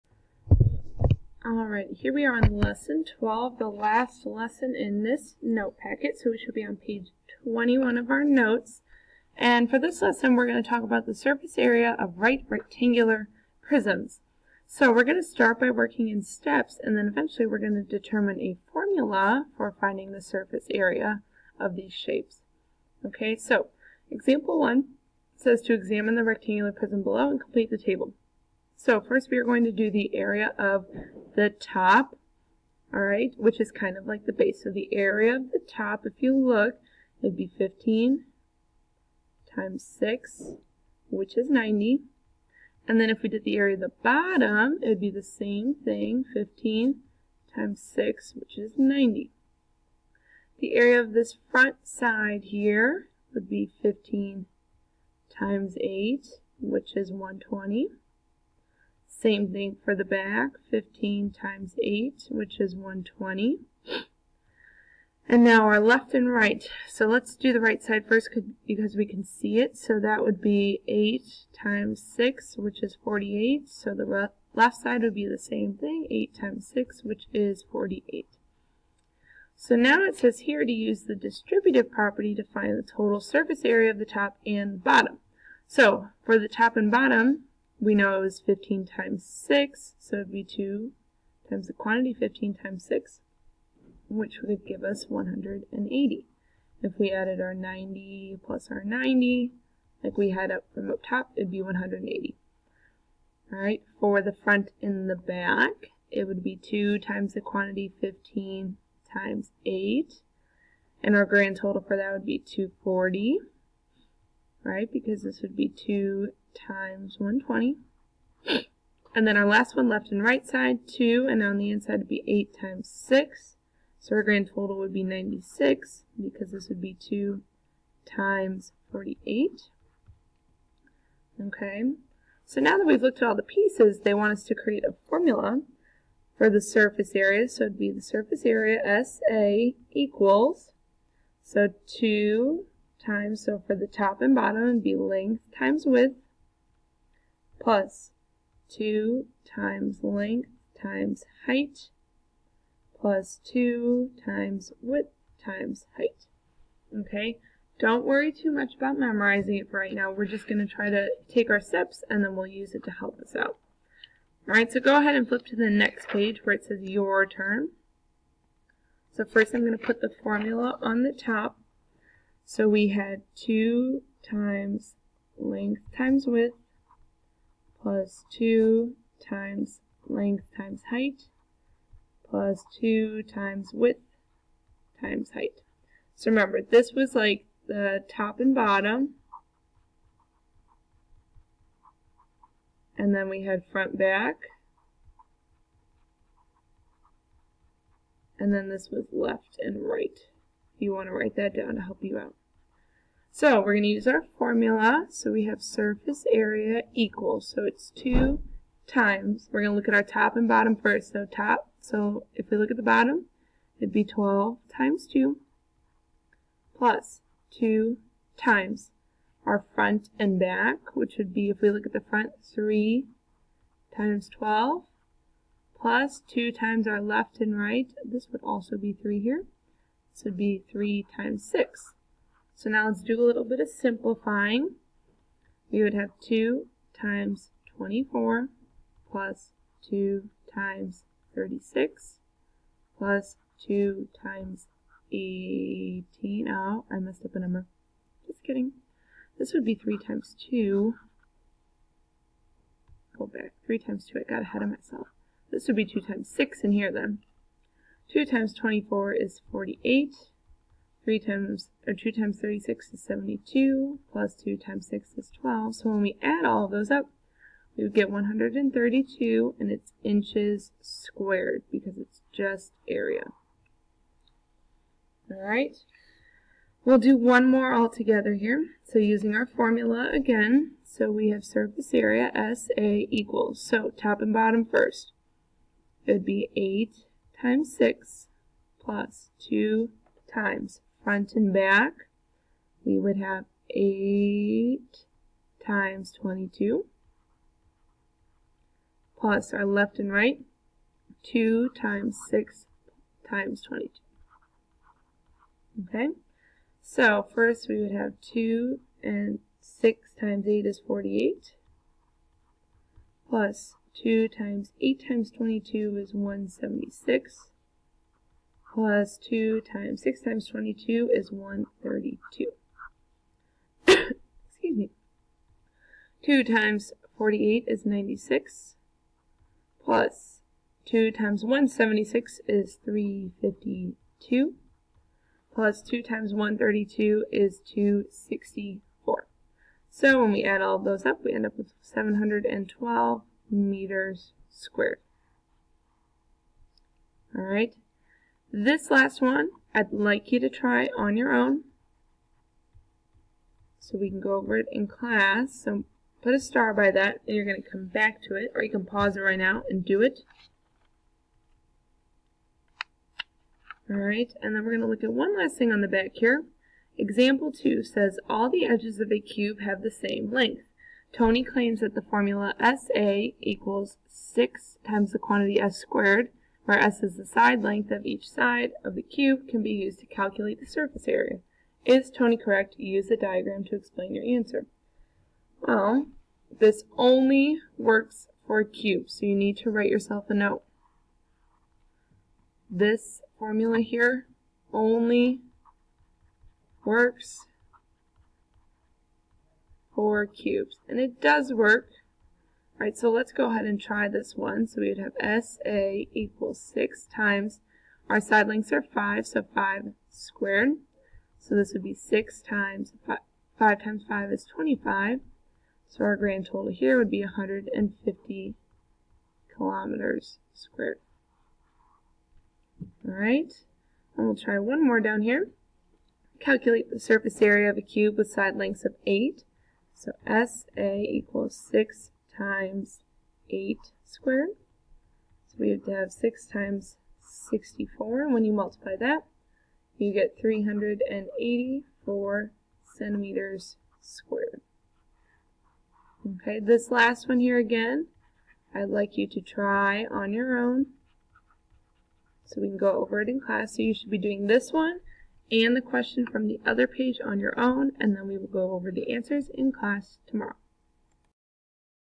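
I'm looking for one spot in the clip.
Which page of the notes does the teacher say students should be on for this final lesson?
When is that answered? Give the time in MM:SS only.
00:06.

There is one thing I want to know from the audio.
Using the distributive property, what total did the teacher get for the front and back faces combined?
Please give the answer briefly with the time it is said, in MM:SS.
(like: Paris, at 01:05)
240, at 01:52.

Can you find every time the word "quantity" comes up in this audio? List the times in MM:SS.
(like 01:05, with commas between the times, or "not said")
01:31, 01:47, 06:15.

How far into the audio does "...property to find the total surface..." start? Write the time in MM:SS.
01:21.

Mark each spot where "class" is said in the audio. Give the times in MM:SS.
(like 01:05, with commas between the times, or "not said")
05:54, 07:33, 07:39.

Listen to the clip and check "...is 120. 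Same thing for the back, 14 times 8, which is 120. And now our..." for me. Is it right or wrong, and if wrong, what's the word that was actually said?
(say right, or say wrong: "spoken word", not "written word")
wrong: "15", not "14".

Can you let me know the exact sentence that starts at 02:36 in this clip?
Okay, don't worry too much about memorizing it for right now.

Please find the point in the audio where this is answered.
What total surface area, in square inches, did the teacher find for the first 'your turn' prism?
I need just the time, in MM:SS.
04:28.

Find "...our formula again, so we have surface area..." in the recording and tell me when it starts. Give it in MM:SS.
04:39.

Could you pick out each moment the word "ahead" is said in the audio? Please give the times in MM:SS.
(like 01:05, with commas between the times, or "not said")
02:44, 04:14, 06:43.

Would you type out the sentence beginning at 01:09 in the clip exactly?
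So that would be 8 times 6, which is 48.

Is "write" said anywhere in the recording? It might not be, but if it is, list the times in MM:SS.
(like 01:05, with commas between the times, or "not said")
03:21, 06:29.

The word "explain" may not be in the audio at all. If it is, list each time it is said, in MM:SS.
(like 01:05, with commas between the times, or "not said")
06:23.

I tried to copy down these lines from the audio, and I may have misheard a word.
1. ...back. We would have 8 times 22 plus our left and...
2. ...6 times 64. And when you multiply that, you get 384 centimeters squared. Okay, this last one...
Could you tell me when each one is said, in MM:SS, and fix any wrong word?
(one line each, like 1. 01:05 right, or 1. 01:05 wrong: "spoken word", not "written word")
1. 04:51 right
2. 07:16 right.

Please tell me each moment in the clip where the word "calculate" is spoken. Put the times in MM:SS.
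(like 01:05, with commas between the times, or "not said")
06:20, 07:06.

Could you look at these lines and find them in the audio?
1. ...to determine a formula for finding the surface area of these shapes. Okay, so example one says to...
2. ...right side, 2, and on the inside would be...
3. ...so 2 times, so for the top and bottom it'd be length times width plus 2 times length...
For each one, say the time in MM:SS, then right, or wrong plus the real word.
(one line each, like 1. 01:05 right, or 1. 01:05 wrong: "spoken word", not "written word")
1. 00:17 right
2. 02:00 right
3. 02:21 right.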